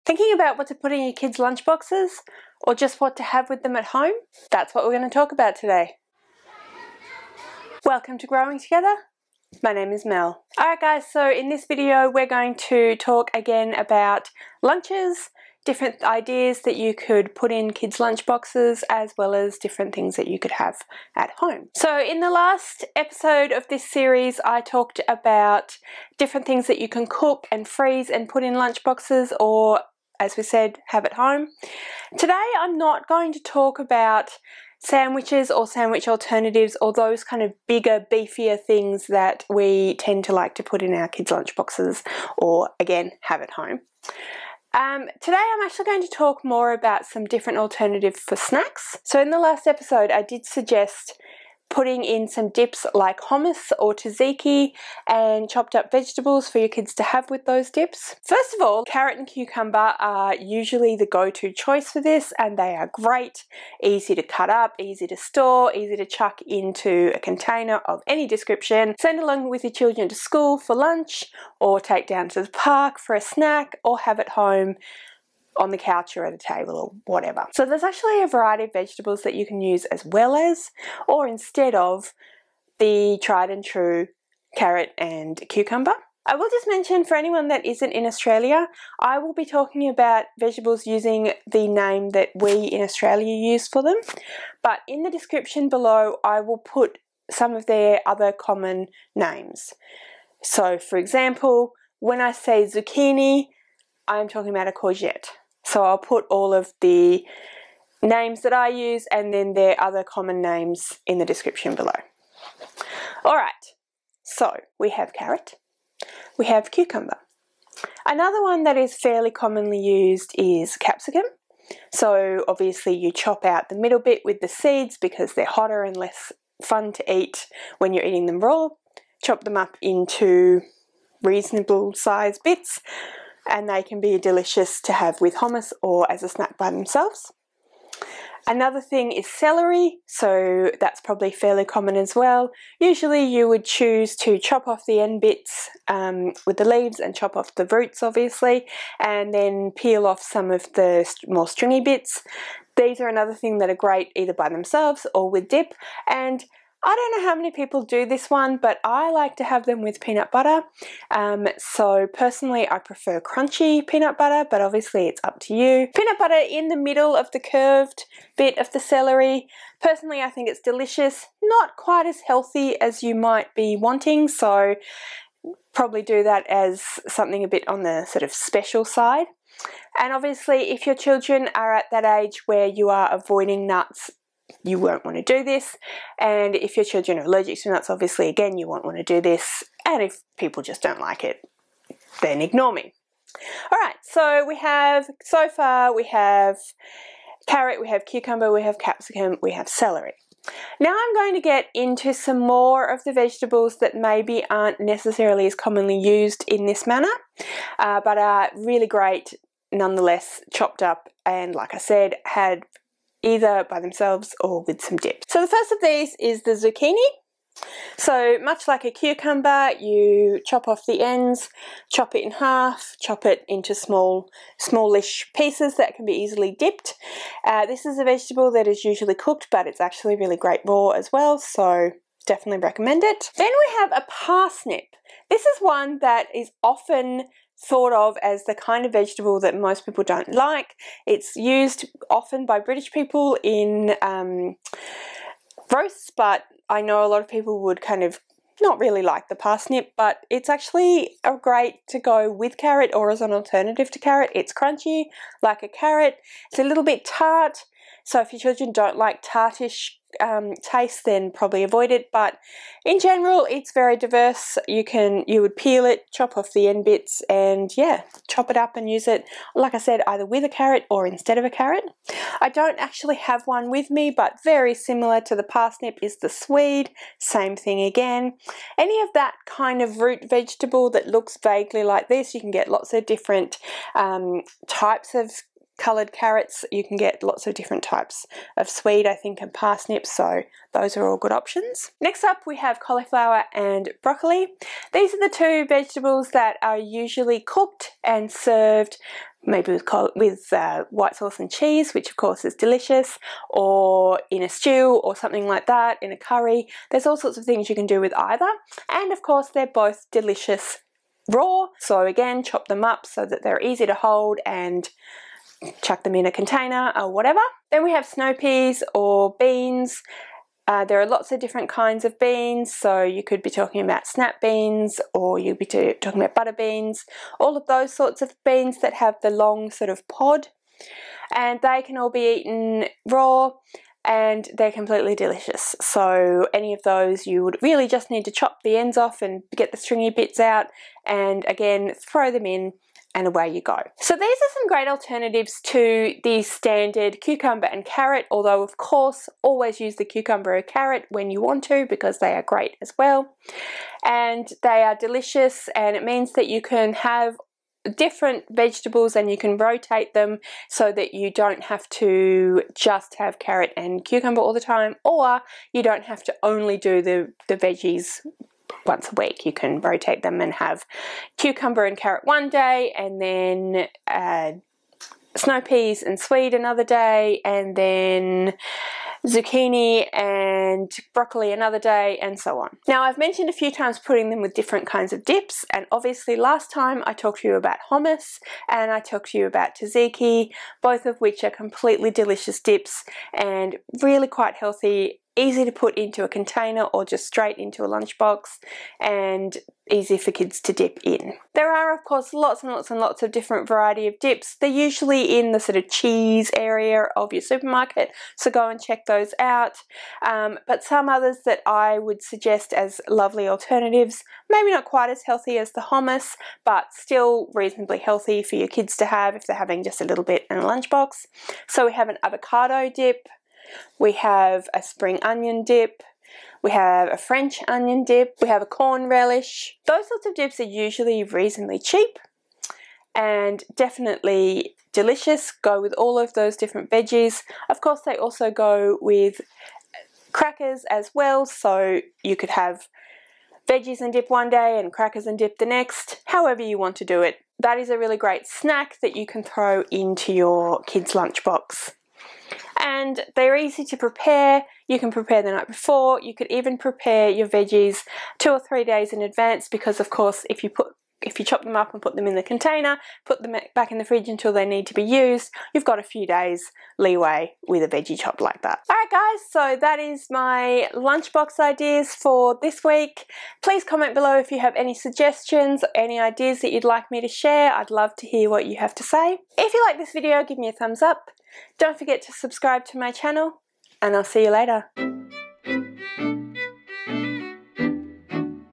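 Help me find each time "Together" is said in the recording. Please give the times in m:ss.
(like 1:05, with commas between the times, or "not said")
0:08.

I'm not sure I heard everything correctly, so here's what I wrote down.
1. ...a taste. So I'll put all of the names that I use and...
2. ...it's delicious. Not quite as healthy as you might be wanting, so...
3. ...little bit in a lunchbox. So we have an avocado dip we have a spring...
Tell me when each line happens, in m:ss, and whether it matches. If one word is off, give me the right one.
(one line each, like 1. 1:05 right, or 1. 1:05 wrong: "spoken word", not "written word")
1. 1:44 wrong: "courgette", not "taste"
2. 2:50 right
3. 7:00 right.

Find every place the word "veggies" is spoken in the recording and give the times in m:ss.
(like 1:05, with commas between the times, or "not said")
6:07, 7:16, 7:23, 7:37, 7:47.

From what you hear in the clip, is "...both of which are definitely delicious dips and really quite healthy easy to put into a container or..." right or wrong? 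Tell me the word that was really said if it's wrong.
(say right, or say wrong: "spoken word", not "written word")
wrong: "completely", not "definitely".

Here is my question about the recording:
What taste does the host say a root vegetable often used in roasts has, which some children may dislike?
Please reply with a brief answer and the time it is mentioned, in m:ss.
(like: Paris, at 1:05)
tart, at 4:16.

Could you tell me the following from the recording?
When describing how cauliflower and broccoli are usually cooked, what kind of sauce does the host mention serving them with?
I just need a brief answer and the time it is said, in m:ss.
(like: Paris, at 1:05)
white sauce, at 5:00.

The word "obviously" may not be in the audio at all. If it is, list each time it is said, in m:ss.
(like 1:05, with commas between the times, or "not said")
2:02, 2:28, 2:44, 3:00, 3:07, 6:25.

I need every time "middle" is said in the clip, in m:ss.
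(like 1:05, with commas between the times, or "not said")
2:03, 2:46.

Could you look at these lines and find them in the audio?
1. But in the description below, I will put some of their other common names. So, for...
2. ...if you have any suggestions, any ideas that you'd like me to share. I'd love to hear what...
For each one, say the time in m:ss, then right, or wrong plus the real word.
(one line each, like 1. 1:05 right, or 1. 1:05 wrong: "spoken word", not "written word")
1. 1:34 right
2. 7:54 right.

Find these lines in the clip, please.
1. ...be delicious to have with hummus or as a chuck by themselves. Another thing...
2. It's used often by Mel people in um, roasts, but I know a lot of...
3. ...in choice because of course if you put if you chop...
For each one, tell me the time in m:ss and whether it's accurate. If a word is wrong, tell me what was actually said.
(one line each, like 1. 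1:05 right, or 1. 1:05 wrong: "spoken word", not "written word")
1. 2:14 wrong: "snack", not "chuck"
2. 4:01 wrong: "British", not "Mel"
3. 7:39 wrong: "advance", not "choice".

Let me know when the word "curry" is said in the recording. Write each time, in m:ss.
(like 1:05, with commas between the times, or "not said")
5:06.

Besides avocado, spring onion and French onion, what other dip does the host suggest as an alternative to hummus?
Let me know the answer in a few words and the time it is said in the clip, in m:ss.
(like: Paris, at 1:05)
corn relish, at 7:08.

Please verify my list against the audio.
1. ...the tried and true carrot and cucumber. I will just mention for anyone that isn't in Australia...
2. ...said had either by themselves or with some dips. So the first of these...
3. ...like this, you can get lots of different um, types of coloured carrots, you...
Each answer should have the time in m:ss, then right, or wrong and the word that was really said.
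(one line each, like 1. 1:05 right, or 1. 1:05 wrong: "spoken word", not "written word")
1. 1:22 right
2. 3:31 right
3. 4:41 right.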